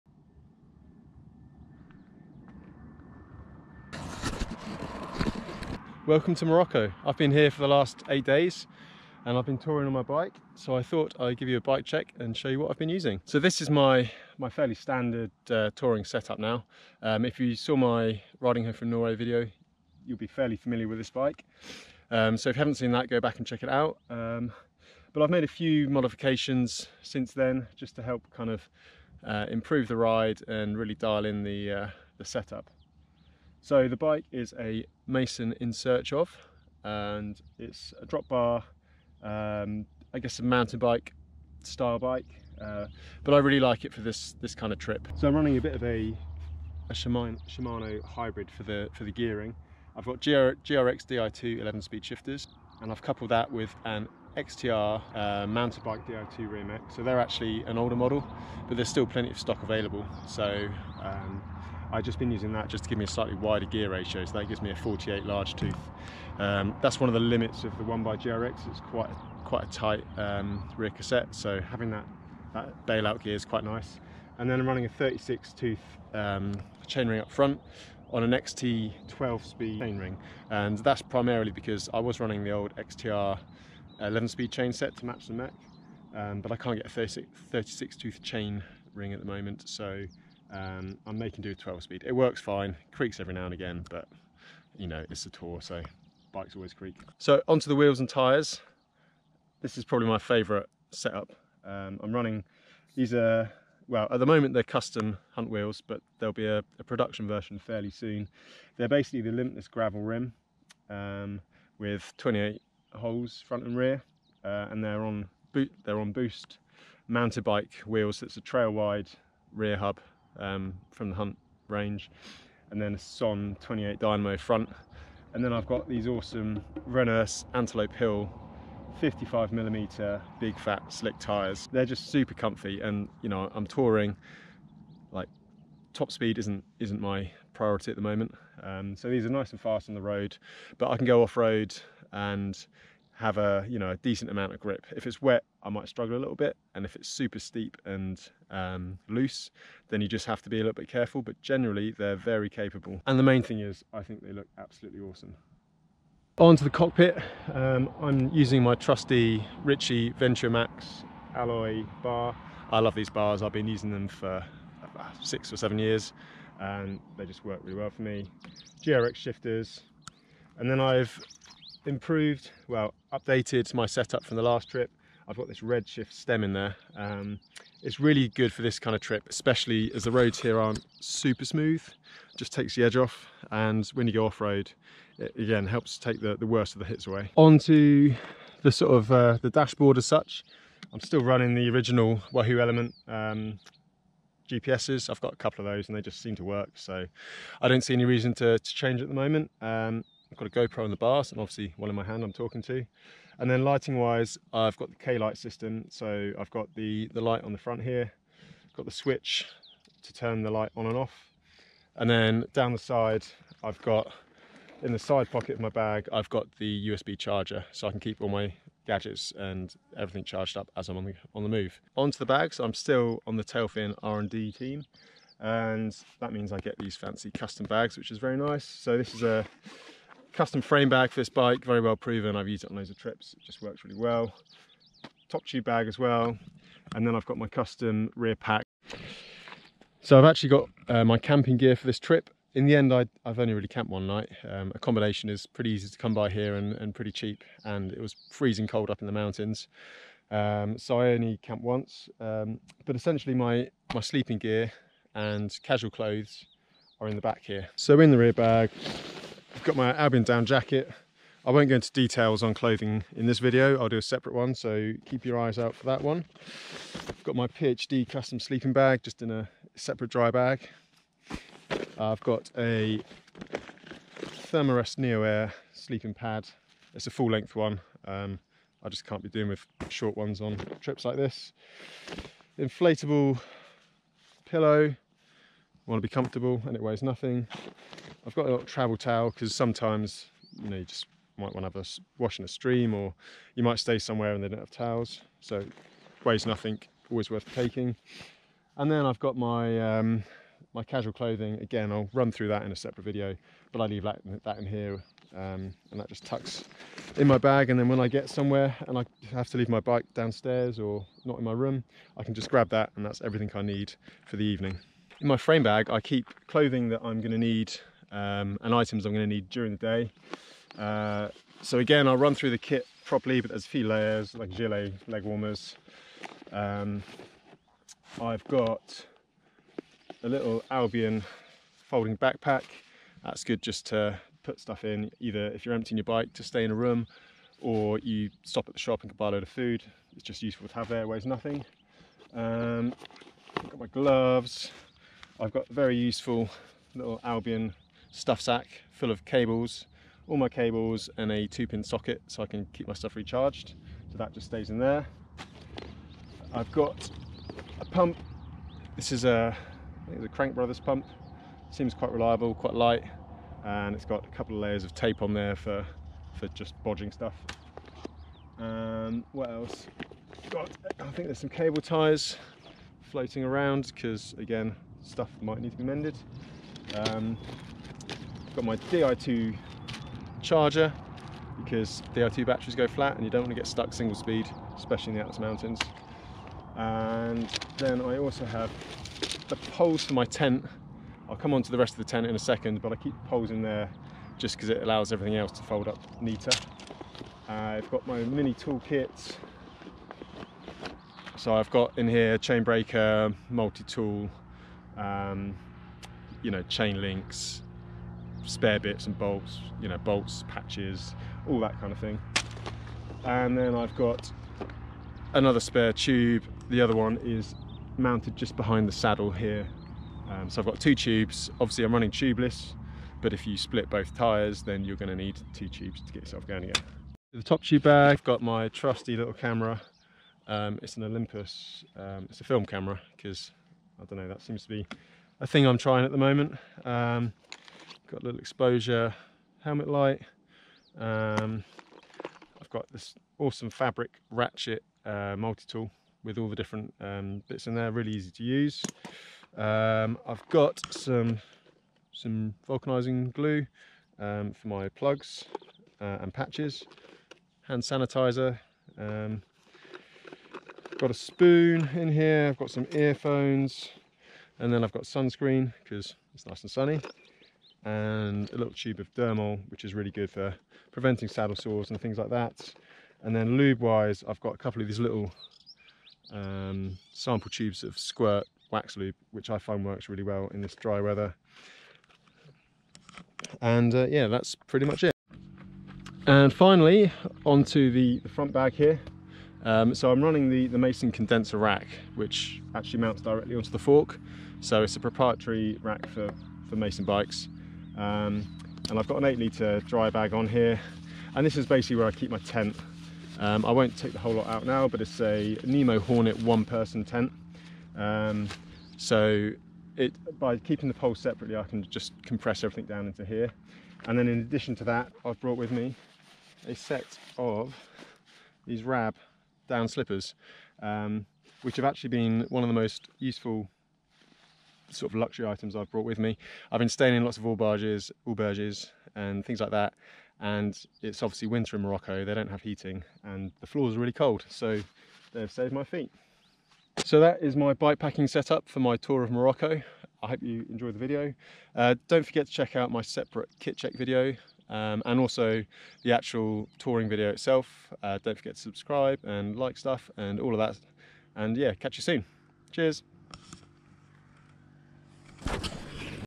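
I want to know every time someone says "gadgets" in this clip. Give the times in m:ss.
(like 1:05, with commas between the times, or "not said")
3:38.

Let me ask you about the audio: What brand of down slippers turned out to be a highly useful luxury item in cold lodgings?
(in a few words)
Rab.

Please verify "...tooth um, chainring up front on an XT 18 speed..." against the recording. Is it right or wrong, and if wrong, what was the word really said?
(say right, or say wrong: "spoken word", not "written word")
wrong: "12", not "18".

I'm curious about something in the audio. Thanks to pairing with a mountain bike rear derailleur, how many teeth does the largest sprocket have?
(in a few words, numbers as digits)
48.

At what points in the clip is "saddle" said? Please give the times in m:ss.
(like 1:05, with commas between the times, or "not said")
6:58, 7:51.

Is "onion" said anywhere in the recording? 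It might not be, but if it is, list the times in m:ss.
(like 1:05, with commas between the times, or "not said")
not said.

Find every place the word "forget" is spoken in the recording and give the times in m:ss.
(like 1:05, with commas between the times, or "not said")
9:02, 9:08.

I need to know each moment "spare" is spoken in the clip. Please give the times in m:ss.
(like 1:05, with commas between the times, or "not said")
6:48, 6:55.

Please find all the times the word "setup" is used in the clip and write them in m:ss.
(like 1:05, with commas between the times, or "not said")
0:16, 0:32, 1:40, 2:53, 8:58.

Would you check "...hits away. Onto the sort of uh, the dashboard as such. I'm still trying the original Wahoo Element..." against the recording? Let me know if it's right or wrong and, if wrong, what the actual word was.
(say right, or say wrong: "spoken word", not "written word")
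wrong: "running", not "trying".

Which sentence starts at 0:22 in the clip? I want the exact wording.
Um, so if you haven't seen that, go back and check it out.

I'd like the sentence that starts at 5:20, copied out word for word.
Uh, so again, I'll run through the kit properly, but there's a few layers like gilet, leg warmers.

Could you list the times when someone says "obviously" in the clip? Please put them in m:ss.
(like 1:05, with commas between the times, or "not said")
3:21, 7:01, 8:51.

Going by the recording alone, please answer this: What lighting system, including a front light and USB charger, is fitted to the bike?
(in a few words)
Klite.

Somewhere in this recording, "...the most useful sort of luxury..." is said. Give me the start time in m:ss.
8:42.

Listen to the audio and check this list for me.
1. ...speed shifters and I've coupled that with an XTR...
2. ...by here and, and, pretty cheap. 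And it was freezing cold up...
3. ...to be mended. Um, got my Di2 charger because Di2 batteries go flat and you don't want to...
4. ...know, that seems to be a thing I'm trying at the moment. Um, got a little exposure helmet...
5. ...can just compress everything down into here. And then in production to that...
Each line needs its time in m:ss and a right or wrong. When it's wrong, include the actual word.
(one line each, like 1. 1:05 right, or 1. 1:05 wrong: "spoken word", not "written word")
1. 0:51 right
2. 4:06 right
3. 6:15 right
4. 7:14 right
5. 8:31 wrong: "addition", not "production".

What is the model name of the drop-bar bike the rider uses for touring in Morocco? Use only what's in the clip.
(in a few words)
Mason InSearchOf.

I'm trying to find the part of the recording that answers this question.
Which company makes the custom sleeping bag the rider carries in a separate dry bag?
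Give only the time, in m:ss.
4:27.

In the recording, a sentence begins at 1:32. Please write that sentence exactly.
It works fine, creaks every now and again, but you know, it's a tour, so bikes always creak.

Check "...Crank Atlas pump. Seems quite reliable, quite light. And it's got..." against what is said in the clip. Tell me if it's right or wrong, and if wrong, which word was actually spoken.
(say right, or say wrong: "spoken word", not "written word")
wrong: "Brothers", not "Atlas".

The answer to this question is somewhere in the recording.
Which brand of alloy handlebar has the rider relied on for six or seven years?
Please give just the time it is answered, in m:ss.
2:39.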